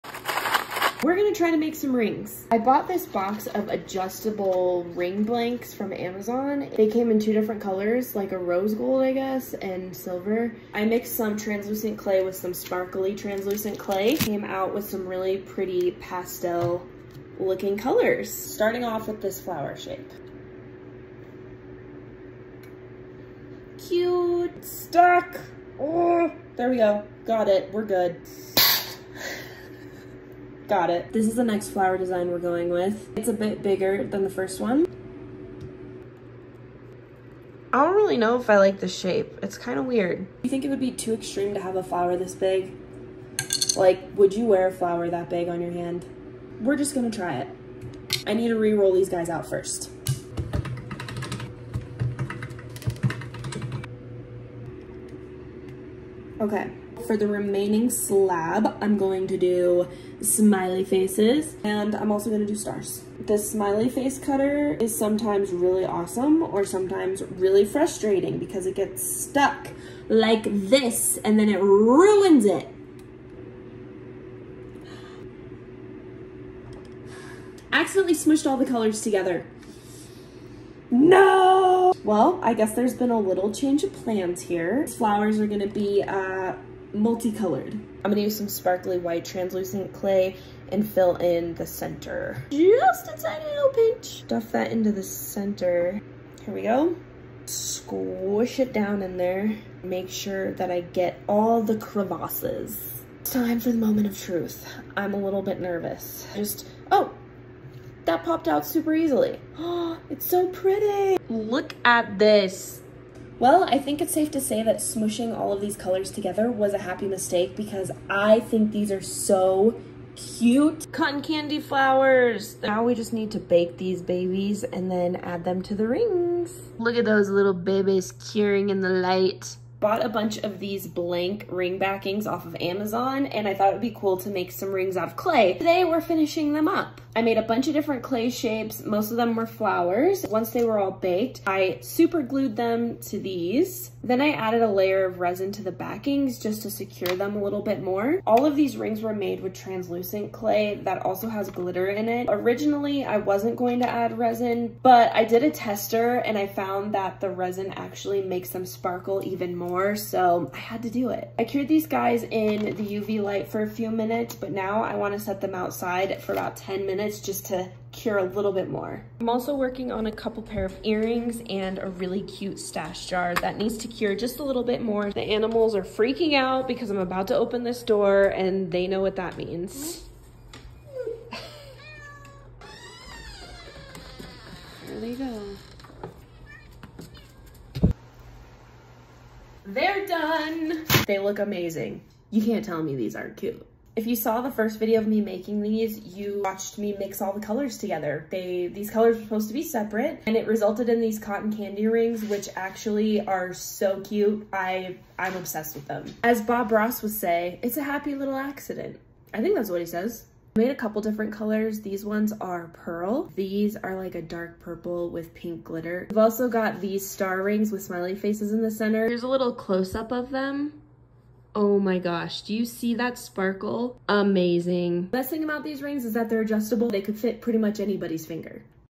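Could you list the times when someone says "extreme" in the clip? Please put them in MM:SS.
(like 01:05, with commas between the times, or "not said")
00:41.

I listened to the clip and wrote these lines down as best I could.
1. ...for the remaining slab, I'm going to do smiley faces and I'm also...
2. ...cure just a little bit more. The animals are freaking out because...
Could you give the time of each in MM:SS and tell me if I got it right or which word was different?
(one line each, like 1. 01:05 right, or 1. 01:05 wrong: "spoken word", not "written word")
1. 00:57 right
2. 02:53 right.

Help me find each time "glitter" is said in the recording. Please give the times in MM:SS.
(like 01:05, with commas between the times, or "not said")
02:31, 03:35.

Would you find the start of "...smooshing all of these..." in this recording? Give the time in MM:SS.
01:54.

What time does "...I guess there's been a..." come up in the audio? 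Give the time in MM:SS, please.
01:22.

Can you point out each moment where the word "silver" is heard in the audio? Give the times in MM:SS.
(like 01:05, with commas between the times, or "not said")
00:09.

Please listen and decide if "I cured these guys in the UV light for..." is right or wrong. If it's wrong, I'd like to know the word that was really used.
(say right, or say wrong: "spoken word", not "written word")
right.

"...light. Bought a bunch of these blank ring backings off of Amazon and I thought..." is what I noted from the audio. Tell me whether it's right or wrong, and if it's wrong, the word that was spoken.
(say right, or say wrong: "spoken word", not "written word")
right.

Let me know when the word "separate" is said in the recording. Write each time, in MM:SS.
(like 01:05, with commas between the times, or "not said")
03:19.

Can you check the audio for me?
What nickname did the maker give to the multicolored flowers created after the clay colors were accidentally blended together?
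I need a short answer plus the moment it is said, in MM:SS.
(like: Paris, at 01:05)
Cotton candy flowers, at 02:00.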